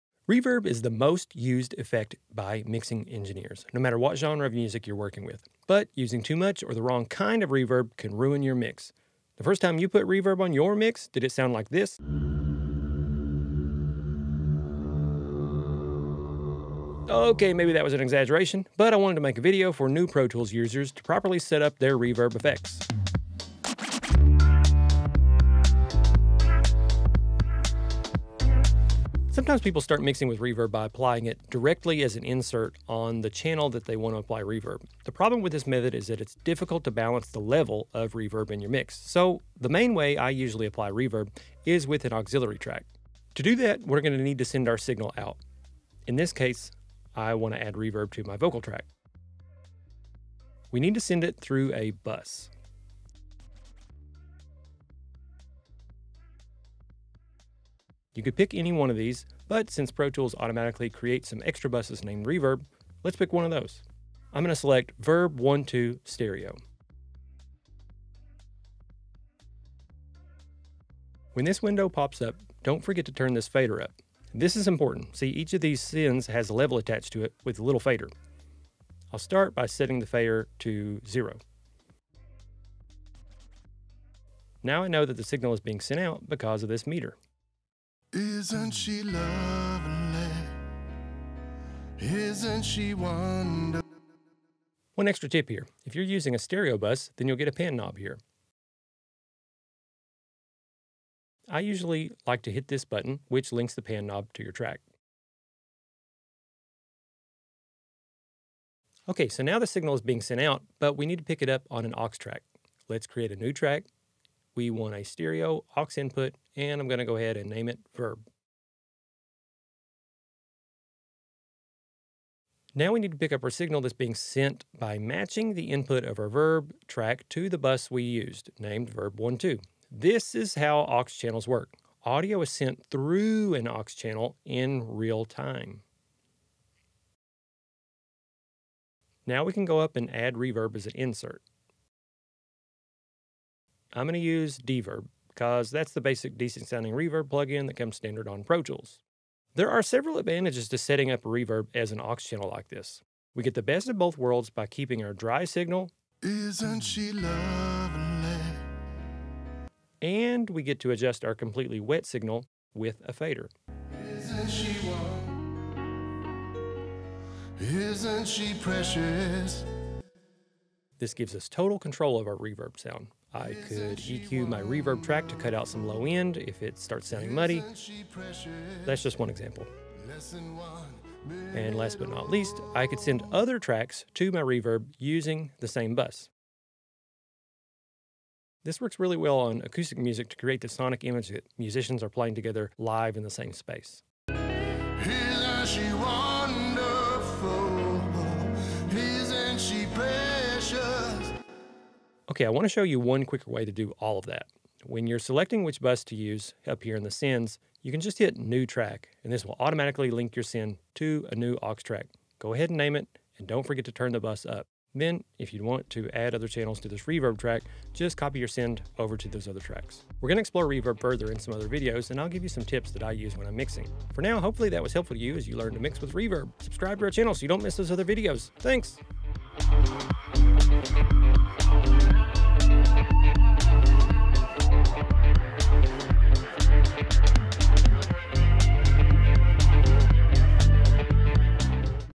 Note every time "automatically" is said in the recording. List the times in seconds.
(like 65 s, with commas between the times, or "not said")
60 s, 209 s.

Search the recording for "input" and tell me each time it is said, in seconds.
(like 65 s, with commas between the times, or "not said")
115 s, 125 s.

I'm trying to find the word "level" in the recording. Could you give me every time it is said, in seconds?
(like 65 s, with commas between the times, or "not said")
37 s, 76 s.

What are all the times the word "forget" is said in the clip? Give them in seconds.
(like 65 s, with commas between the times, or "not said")
72 s, 213 s.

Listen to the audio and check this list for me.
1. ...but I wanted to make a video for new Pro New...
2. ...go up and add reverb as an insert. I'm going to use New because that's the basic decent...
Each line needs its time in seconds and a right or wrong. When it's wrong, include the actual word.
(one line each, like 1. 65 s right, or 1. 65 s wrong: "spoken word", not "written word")
1. 18 s wrong: "Tools", not "New"
2. 139 s wrong: "Dverb", not "New".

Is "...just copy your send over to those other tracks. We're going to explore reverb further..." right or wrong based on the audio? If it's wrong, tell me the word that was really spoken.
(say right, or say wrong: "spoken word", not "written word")
right.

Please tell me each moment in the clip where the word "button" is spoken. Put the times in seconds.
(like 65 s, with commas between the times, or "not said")
102 s.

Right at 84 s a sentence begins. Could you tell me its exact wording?
Now I know that the signal is being sent out because of this meter.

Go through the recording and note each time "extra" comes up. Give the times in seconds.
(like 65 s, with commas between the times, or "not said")
61 s, 95 s.